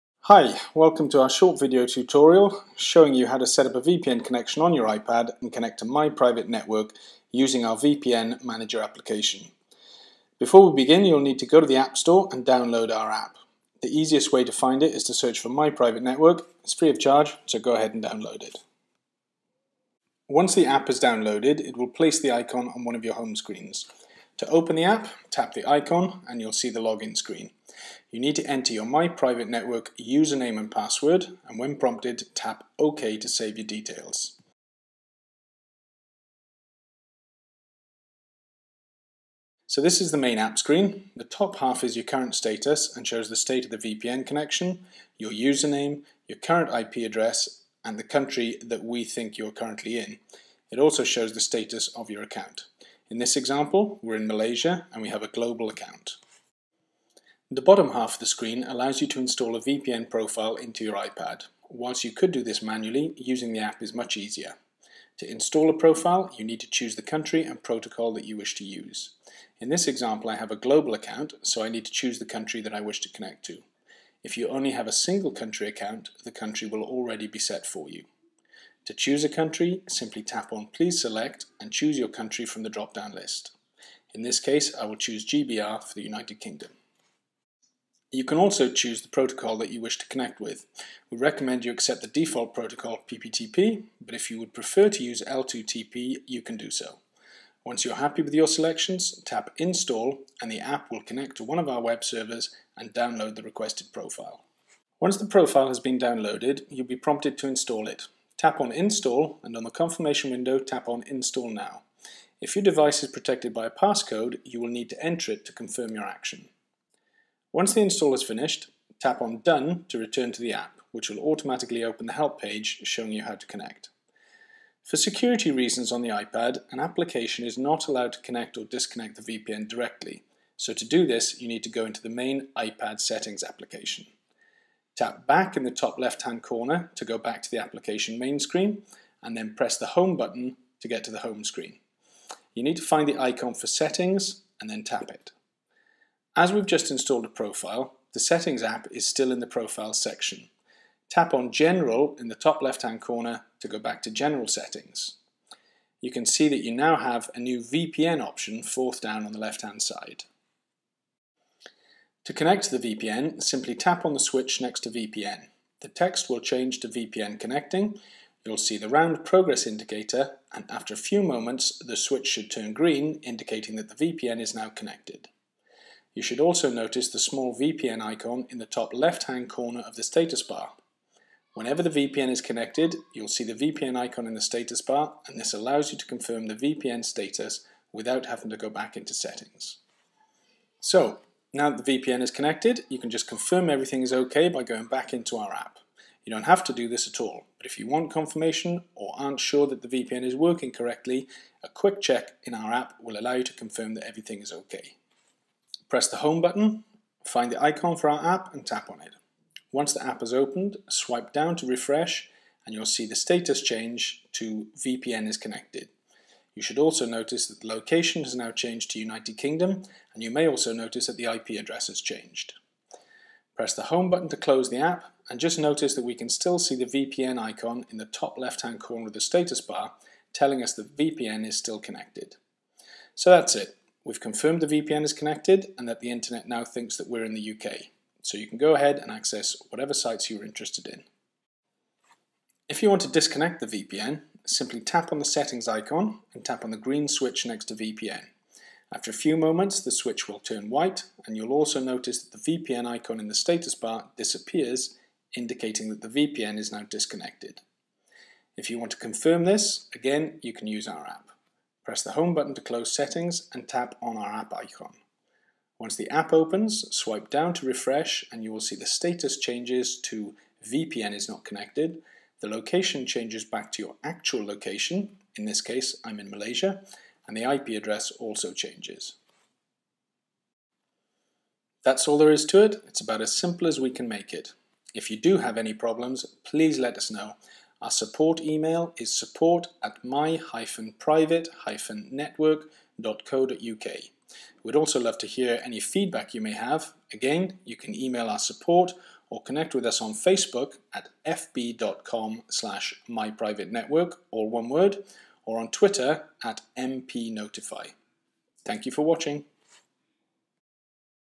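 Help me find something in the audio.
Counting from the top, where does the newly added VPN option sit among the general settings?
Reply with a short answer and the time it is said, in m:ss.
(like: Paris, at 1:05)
fourth, at 2:38.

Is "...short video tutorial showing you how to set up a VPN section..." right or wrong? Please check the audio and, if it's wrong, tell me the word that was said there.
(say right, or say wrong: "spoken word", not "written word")
wrong: "connection", not "section".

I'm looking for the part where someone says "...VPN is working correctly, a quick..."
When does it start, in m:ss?
3:19.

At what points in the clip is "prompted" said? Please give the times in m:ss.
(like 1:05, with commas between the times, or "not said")
0:31, 1:46.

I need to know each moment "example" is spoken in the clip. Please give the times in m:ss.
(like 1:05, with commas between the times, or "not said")
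0:53, 1:09.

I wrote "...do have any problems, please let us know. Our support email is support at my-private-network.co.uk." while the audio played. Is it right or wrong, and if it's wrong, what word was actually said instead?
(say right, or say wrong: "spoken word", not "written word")
right.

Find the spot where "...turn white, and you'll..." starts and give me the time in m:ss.
4:10.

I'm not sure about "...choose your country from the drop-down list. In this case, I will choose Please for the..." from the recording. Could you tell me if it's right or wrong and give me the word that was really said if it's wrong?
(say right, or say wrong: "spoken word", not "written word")
wrong: "GBR", not "Please".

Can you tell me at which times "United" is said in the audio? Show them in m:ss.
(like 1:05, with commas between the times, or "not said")
1:26, 3:38.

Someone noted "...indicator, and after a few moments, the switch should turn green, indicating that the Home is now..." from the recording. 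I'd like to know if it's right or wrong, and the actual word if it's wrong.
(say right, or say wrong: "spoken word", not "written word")
wrong: "VPN", not "Home".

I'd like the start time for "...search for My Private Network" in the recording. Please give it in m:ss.
0:15.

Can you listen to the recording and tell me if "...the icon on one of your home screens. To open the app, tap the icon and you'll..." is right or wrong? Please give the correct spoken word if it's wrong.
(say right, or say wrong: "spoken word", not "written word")
right.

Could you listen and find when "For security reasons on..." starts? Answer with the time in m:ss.
2:04.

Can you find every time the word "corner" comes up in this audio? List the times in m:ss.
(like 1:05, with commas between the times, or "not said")
2:16, 2:33, 2:59, 3:48.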